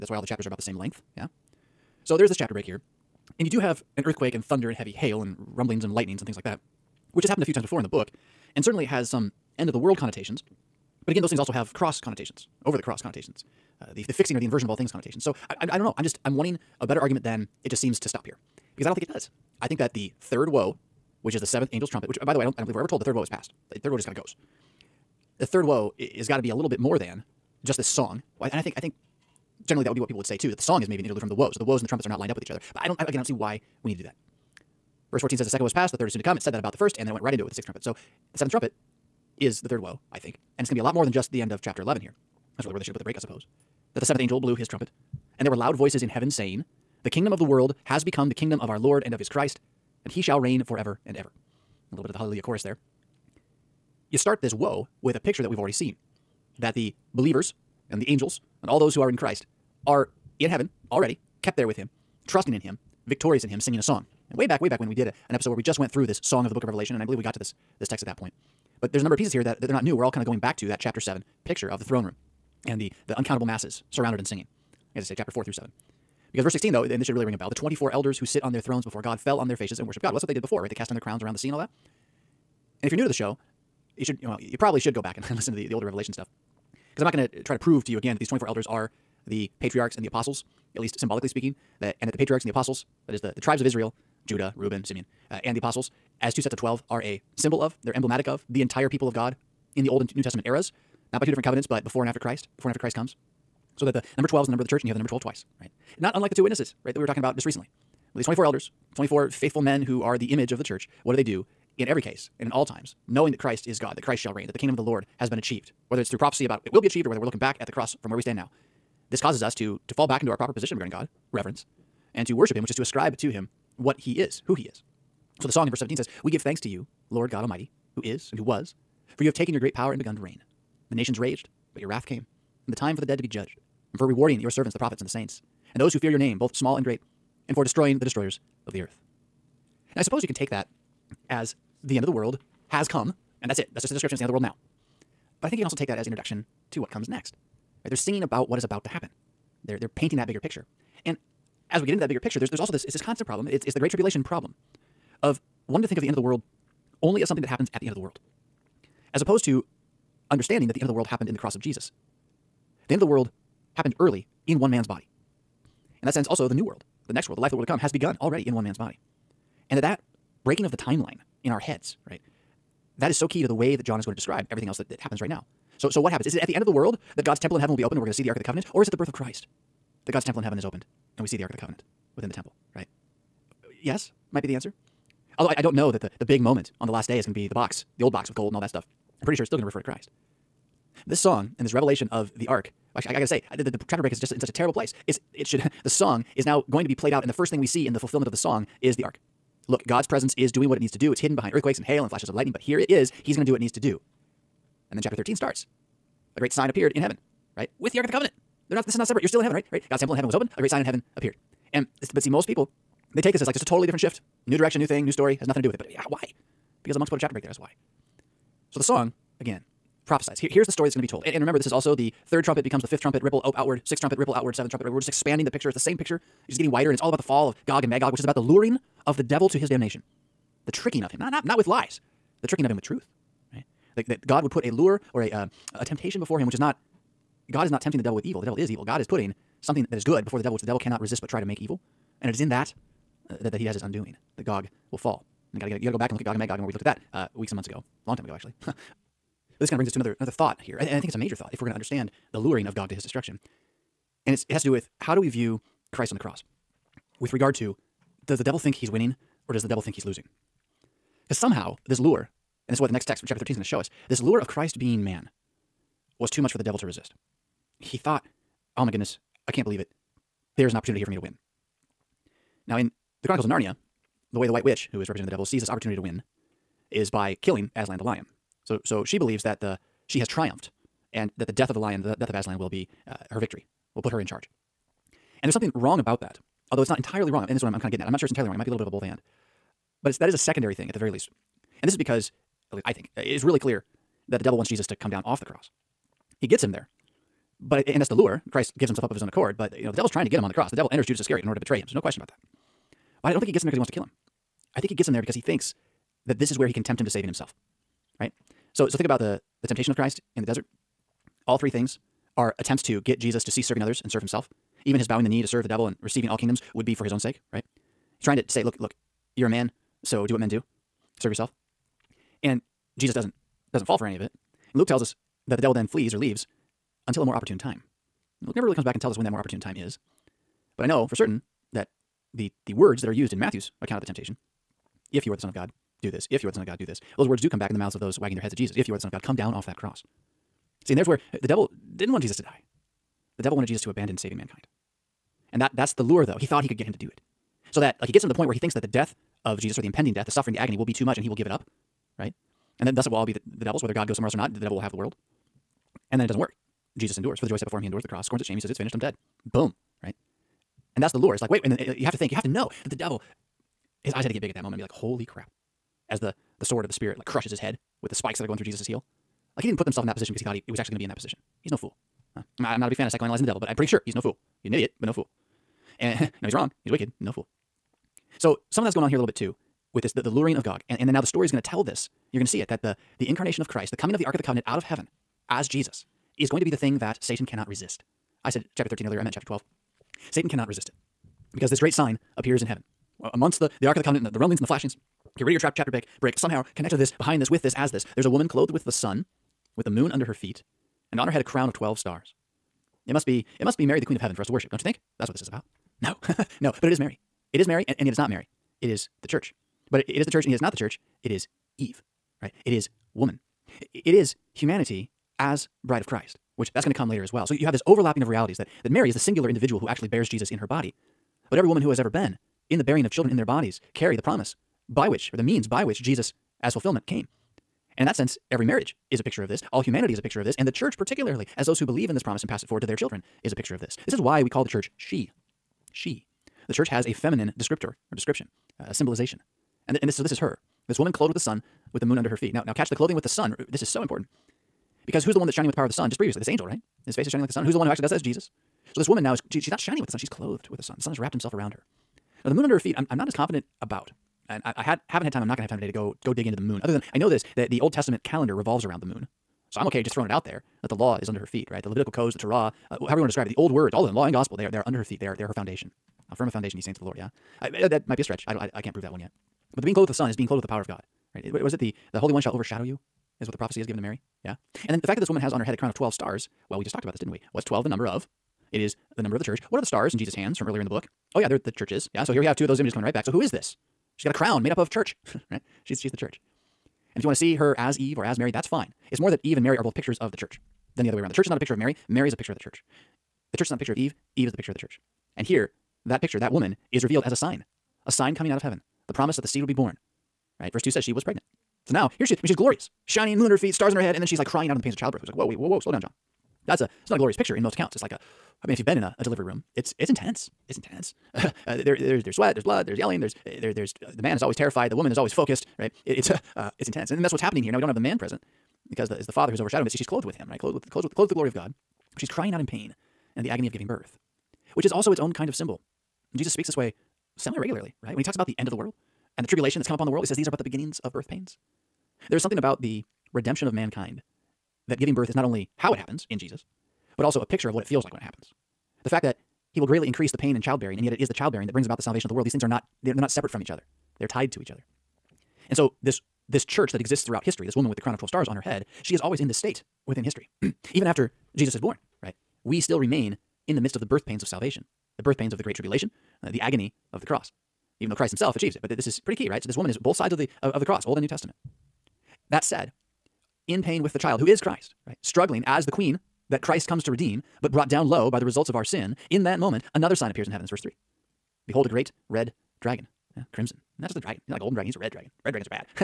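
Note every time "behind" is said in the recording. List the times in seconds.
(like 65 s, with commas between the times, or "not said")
201 s, 397 s.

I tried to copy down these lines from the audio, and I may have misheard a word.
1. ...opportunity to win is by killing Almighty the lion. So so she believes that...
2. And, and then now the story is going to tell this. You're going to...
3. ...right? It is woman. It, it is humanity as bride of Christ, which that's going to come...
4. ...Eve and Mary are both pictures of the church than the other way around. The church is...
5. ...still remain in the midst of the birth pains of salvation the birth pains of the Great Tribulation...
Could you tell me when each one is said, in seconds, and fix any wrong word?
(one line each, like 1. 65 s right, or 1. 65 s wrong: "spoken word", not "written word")
1. 275 s wrong: "Aslan", not "Almighty"
2. 380 s right
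3. 412 s right
4. 489 s right
5. 552 s right.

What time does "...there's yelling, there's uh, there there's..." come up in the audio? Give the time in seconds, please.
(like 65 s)
512 s.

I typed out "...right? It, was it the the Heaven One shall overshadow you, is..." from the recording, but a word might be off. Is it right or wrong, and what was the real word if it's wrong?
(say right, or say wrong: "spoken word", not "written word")
wrong: "Holy", not "Heaven".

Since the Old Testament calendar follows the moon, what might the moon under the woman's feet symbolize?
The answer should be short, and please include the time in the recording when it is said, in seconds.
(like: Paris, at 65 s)
the law, at 460 s.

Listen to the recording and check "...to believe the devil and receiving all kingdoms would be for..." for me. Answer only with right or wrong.
wrong.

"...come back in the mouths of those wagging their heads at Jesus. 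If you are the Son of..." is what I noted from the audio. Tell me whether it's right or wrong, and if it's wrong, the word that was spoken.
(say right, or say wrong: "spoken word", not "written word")
right.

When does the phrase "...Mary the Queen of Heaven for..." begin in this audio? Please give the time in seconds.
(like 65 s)
403 s.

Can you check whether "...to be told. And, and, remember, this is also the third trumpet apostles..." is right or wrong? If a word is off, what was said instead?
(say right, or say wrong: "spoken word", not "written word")
wrong: "becomes", not "apostles".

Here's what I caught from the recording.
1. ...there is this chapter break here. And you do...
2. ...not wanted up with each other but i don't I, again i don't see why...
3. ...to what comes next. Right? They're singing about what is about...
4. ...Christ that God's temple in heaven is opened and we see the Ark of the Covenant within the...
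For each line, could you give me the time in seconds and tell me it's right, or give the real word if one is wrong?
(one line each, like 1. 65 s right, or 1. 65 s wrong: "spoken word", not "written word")
1. 2 s right
2. 32 s wrong: "lined", not "wanted"
3. 146 s right
4. 179 s right.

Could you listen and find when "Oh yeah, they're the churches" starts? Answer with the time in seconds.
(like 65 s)
481 s.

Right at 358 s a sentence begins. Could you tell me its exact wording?
He says, It's finished, I'm dead.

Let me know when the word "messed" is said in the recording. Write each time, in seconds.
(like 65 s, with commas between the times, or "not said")
not said.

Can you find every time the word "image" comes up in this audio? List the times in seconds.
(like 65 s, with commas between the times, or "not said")
110 s, 482 s.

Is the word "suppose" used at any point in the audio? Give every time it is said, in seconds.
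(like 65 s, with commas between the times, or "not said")
43 s, 140 s.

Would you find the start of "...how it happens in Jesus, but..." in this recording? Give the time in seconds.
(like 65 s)
535 s.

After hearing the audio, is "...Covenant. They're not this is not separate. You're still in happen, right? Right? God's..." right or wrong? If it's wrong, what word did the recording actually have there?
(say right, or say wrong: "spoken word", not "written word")
wrong: "heaven", not "happen".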